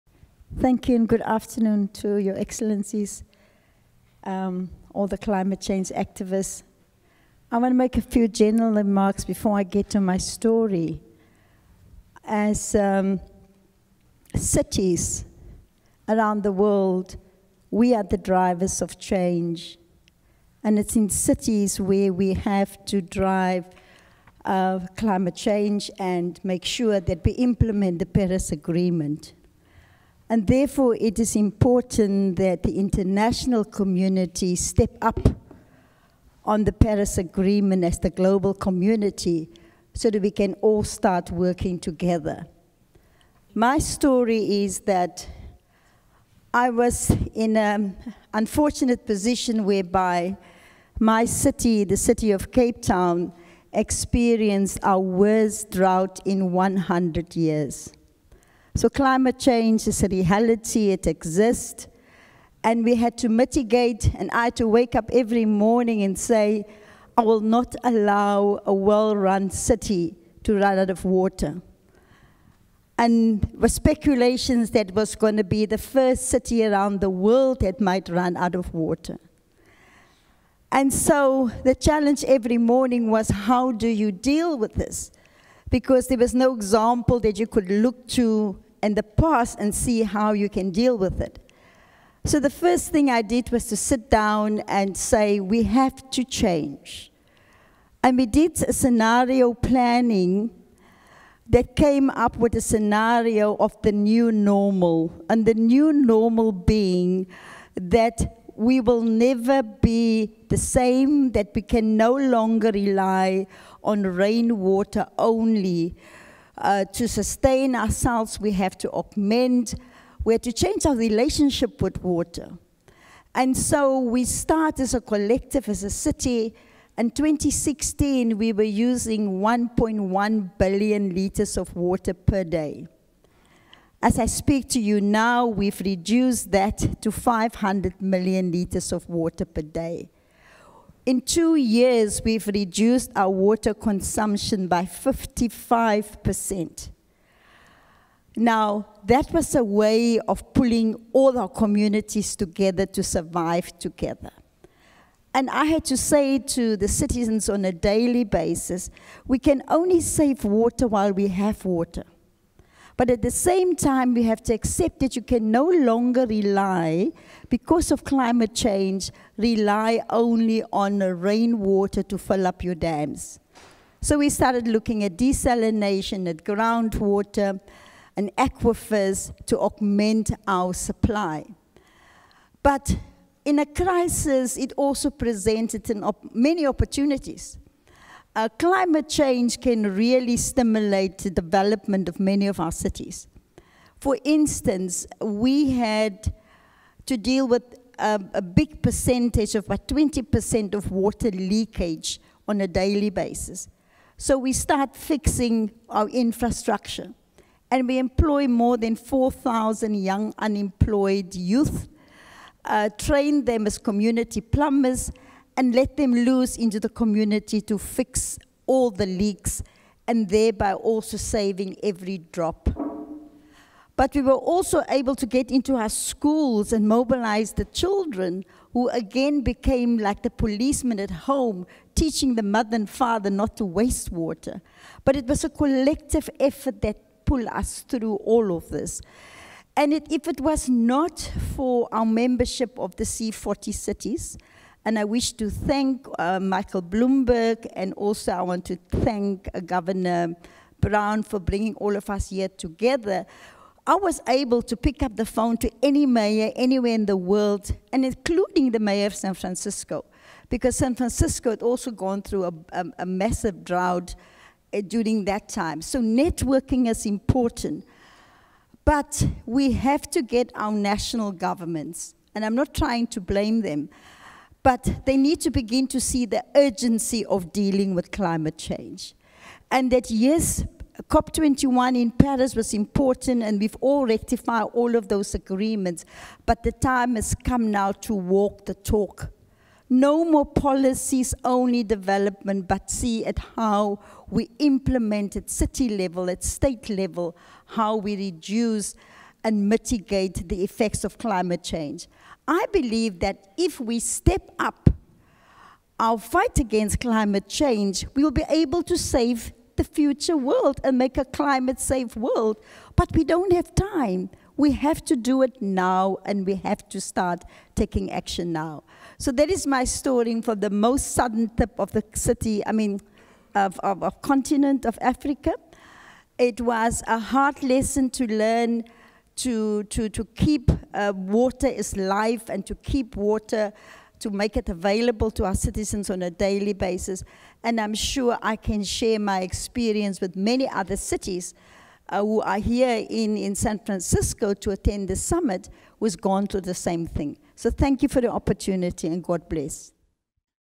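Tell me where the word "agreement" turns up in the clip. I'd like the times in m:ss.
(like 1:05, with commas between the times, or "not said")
0:28, 0:37, 4:45.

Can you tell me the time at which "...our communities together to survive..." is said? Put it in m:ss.
2:31.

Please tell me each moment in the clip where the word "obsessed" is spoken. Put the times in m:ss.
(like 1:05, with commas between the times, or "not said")
not said.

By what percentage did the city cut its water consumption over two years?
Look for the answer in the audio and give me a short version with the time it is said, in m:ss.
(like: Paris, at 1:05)
55%, at 2:24.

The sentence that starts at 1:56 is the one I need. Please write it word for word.
Uh, to sustain ourselves, we have to augment, we have to change our relationship with water.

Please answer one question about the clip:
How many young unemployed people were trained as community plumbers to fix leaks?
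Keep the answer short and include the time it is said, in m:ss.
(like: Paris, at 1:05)
4,000, at 3:28.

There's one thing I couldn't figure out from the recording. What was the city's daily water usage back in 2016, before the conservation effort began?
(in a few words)
1.1 billion liters.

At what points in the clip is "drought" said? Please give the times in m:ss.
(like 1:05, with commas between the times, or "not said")
0:55, 4:23.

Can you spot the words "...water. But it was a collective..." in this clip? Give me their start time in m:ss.
3:54.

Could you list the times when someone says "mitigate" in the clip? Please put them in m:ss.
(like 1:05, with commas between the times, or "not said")
1:03, 4:59.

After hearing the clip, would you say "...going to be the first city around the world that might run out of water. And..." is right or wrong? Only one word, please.
right.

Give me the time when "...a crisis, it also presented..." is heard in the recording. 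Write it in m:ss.
3:03.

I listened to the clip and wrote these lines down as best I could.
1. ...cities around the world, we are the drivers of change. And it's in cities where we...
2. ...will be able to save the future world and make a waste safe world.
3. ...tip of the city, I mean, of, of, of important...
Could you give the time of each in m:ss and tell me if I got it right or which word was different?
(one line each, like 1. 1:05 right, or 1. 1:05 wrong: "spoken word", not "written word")
1. 0:14 right
2. 5:08 wrong: "climate", not "waste"
3. 5:21 wrong: "continent", not "important".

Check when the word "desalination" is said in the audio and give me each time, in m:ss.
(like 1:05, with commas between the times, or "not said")
2:55.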